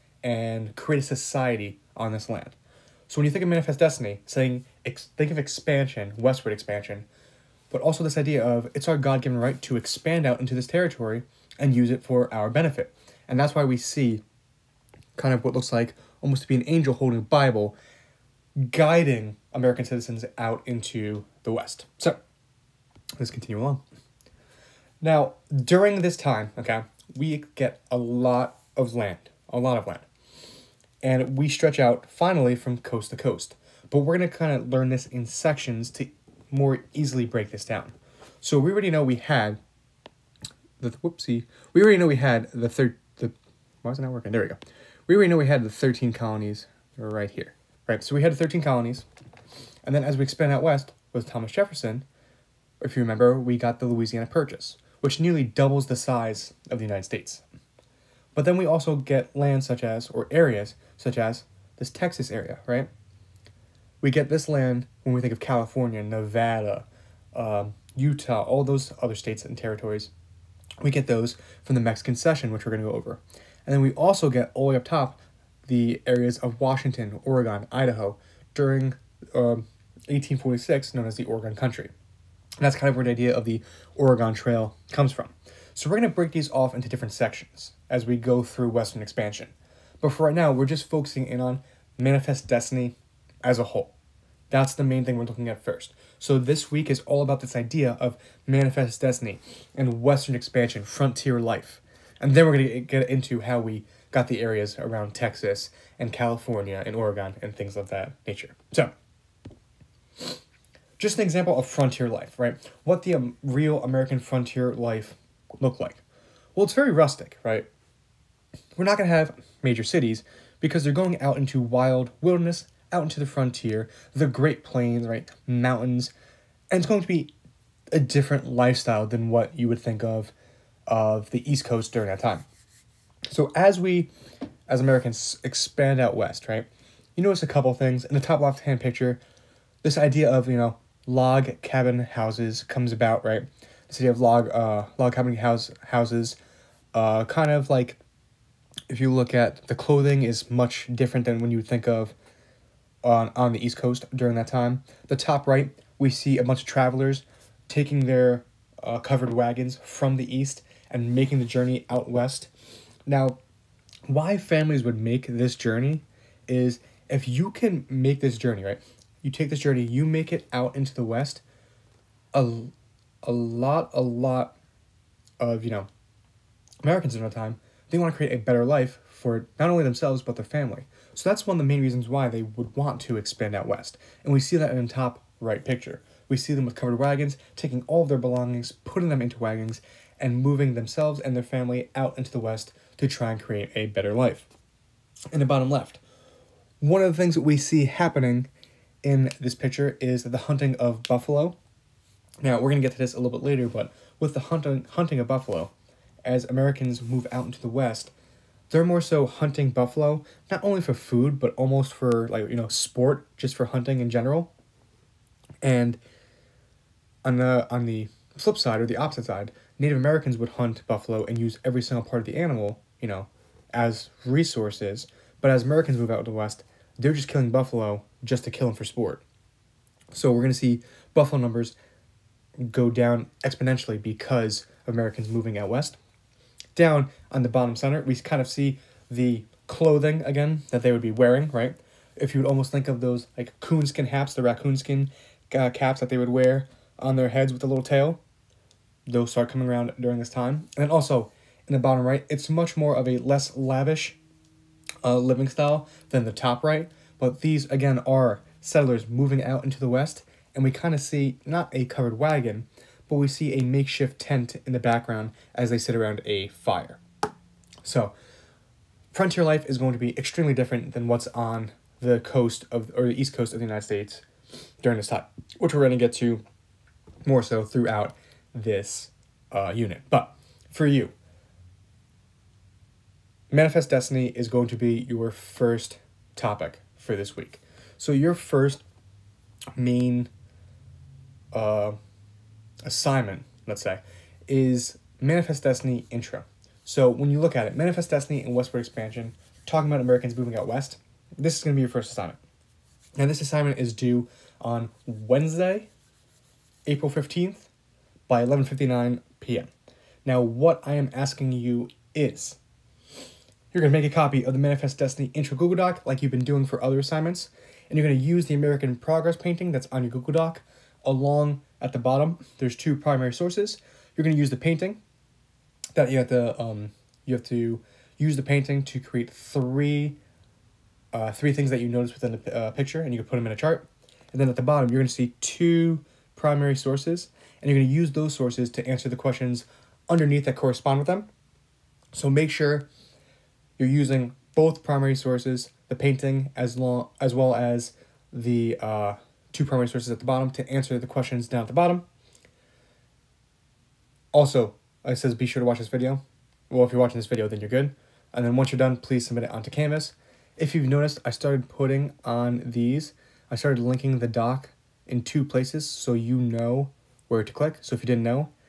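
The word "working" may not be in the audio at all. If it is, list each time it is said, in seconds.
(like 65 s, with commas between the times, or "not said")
44 s.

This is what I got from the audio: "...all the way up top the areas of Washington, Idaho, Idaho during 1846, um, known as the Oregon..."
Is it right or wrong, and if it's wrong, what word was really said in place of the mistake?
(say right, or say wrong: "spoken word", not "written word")
wrong: "Oregon", not "Idaho".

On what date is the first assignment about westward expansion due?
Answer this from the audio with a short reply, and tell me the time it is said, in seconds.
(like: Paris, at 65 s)
Wednesday, April 15th, at 305 s.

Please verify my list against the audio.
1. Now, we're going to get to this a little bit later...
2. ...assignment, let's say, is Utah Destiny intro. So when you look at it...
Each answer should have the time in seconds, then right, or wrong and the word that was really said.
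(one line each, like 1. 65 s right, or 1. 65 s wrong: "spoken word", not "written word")
1. 202 s right
2. 292 s wrong: "Manifest", not "Utah".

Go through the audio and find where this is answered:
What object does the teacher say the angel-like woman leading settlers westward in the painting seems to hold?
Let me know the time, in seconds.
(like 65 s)
17 s.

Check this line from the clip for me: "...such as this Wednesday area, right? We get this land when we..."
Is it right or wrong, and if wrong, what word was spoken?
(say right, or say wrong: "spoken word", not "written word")
wrong: "Texas", not "Wednesday".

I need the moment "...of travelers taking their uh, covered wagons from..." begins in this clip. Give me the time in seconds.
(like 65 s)
156 s.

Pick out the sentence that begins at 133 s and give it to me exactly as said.
So as we, as Americans, expand out west, right?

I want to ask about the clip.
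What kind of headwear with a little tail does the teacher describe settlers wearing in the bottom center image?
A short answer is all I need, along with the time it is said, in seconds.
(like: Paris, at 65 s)
Coonskin hats, at 243 s.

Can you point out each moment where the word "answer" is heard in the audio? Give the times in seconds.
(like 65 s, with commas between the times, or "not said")
338 s, 350 s.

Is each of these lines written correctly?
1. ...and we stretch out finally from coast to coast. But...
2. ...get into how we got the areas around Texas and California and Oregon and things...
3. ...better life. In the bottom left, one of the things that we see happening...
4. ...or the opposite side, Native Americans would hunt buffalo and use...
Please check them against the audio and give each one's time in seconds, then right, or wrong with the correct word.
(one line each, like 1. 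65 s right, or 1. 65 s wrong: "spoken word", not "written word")
1. 31 s right
2. 102 s right
3. 193 s right
4. 218 s right.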